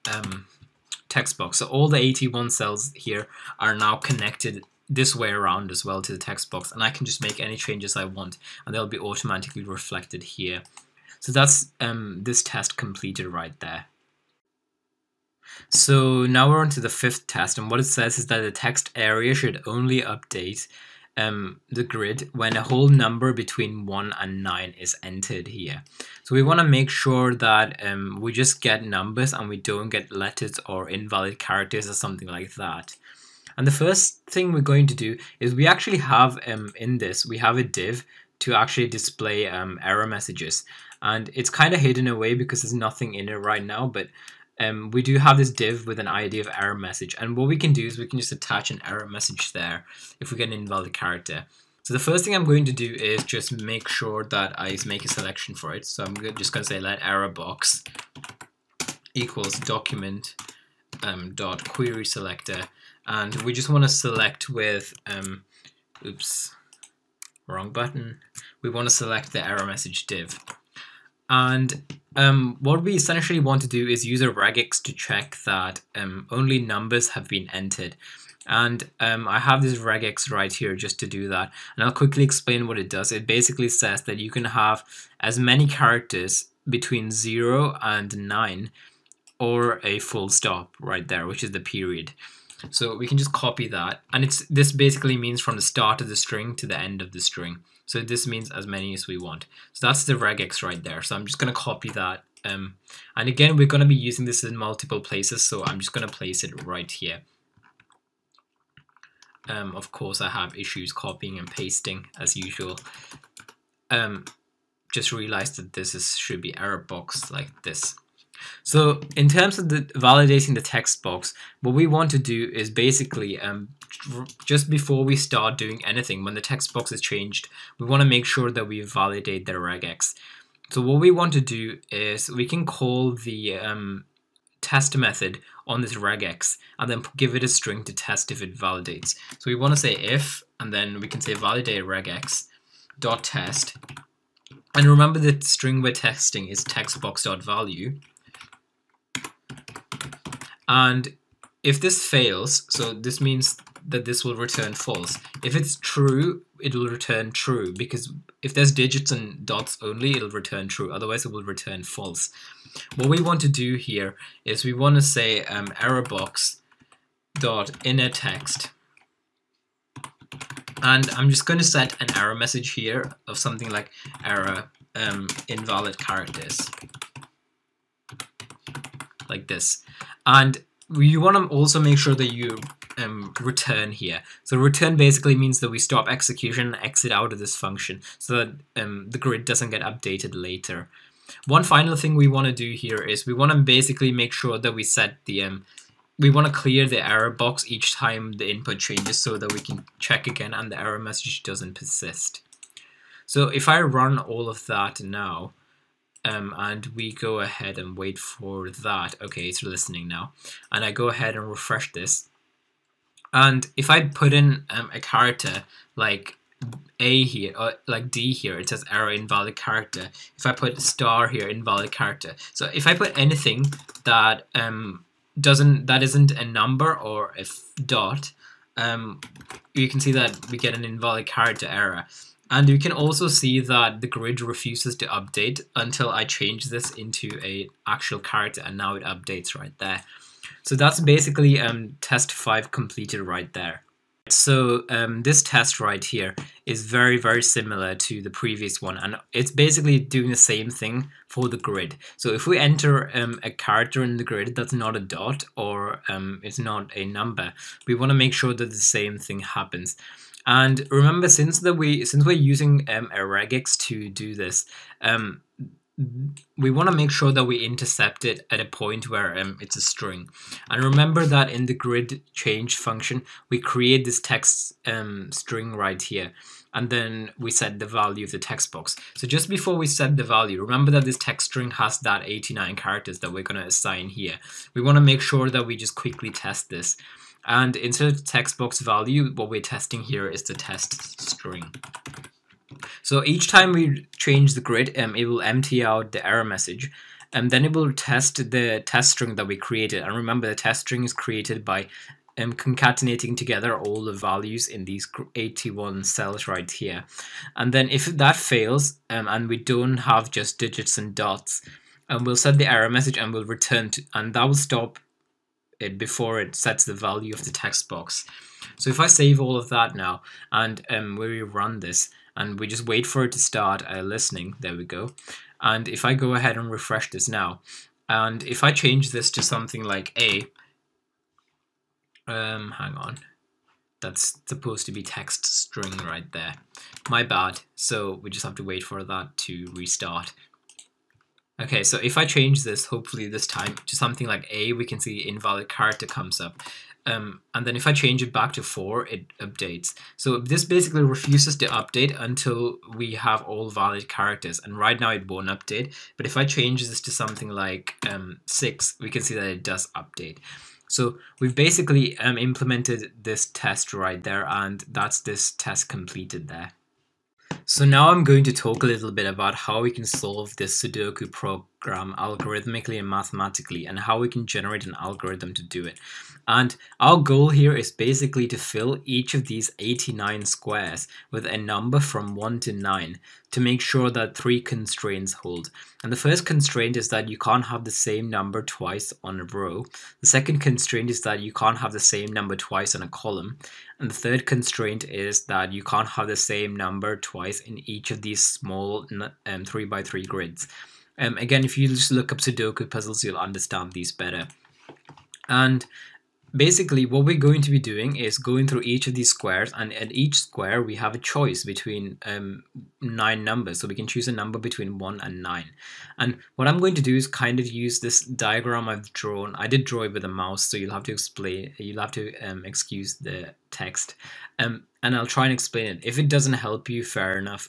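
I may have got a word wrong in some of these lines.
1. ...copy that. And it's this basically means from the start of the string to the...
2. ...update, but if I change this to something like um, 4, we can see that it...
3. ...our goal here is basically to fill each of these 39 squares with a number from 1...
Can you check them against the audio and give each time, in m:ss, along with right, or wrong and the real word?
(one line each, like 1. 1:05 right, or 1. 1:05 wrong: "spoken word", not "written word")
1. 1:33 right
2. 5:55 wrong: "6", not "4"
3. 6:16 wrong: "89", not "39".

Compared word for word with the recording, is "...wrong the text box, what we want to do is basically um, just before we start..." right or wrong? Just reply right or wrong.
wrong.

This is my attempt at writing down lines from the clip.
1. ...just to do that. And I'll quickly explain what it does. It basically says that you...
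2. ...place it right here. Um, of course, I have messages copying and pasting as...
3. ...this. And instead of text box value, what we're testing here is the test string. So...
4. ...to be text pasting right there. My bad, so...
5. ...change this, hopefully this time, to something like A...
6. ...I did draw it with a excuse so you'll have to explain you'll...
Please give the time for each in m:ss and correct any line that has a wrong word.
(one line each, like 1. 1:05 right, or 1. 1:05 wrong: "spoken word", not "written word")
1. 1:20 right
2. 1:46 wrong: "issues", not "messages"
3. 4:46 right
4. 5:34 wrong: "string", not "pasting"
5. 5:42 right
6. 6:59 wrong: "mouse", not "excuse".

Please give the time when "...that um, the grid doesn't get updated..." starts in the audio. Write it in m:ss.
3:08.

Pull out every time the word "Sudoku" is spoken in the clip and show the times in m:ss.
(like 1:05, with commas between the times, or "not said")
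6:10, 6:42.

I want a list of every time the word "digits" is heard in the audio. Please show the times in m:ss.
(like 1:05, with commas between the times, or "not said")
2:38, 5:10.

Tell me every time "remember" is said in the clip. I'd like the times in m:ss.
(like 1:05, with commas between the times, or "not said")
2:24, 4:20, 4:30, 4:40, 5:00.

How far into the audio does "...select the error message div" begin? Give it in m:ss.
1:08.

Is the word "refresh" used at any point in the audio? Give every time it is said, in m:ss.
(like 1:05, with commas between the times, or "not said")
3:31, 5:26.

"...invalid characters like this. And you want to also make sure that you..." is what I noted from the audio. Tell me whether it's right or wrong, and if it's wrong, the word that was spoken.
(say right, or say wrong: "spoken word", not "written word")
right.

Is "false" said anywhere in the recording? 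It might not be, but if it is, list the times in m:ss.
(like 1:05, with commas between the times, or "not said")
2:34, 2:41.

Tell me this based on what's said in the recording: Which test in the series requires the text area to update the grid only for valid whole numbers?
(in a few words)
fifth.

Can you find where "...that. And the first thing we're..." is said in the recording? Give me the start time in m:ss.
0:32.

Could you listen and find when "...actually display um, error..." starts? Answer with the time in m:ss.
0:38.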